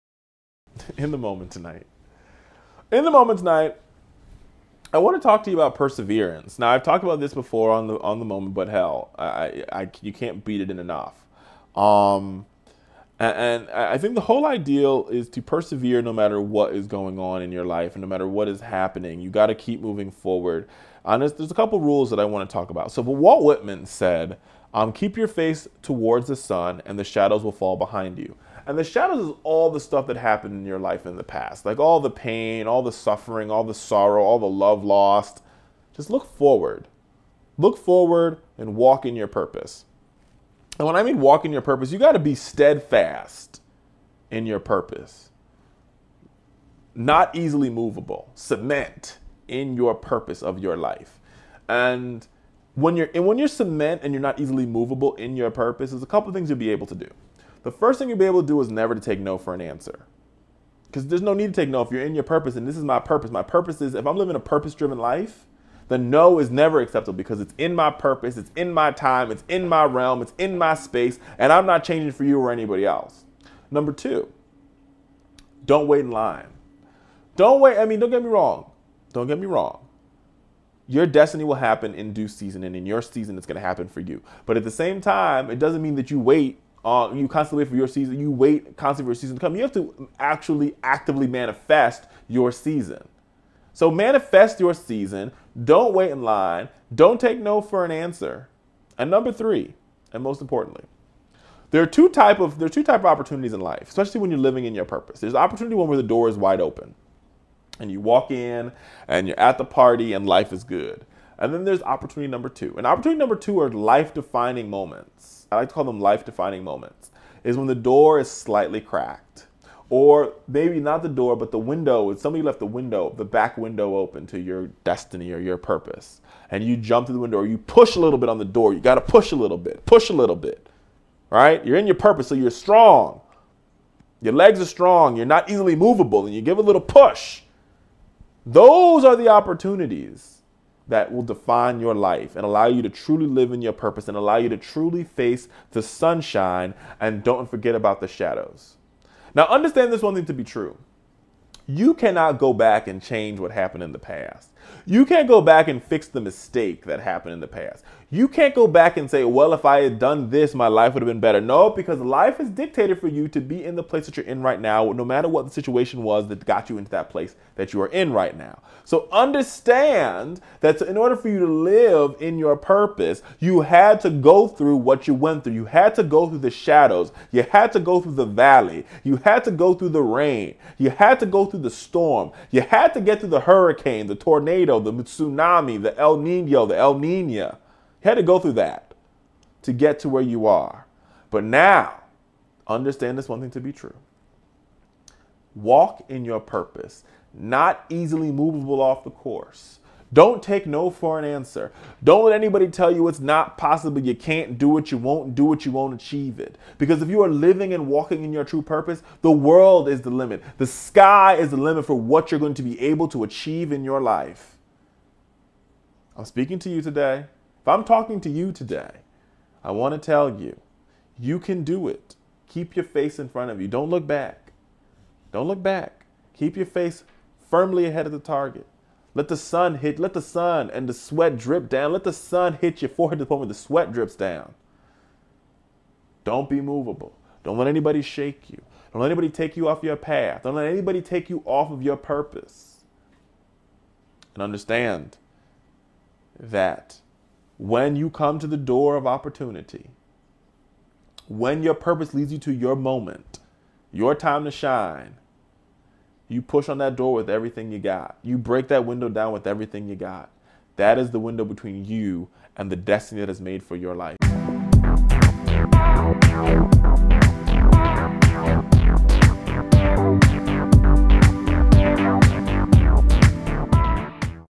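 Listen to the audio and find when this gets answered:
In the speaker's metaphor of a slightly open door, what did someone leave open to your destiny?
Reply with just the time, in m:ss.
2:03.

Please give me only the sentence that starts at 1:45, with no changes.
There's opportunity one where the door is wide open, and you walk in and you're at the party and life is good.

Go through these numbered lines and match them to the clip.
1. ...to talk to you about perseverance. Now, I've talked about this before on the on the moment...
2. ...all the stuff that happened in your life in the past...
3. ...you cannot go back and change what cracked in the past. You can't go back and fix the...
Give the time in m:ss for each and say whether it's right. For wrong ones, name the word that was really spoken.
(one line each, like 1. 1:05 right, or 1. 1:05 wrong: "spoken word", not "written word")
1. 0:05 right
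2. 0:29 right
3. 2:31 wrong: "happened", not "cracked".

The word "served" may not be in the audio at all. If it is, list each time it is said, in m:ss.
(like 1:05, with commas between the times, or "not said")
not said.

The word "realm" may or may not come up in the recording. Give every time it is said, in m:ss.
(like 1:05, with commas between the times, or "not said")
1:09.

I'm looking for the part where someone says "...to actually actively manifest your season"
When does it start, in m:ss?
1:29.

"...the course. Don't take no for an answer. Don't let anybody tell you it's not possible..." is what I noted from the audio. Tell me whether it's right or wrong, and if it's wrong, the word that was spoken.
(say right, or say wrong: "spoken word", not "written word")
right.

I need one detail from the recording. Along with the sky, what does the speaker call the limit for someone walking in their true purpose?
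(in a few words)
the world.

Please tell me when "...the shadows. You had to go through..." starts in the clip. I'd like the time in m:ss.
2:56.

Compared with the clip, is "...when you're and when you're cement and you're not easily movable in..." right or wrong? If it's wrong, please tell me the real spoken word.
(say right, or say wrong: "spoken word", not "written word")
right.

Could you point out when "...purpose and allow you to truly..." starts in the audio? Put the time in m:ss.
2:23.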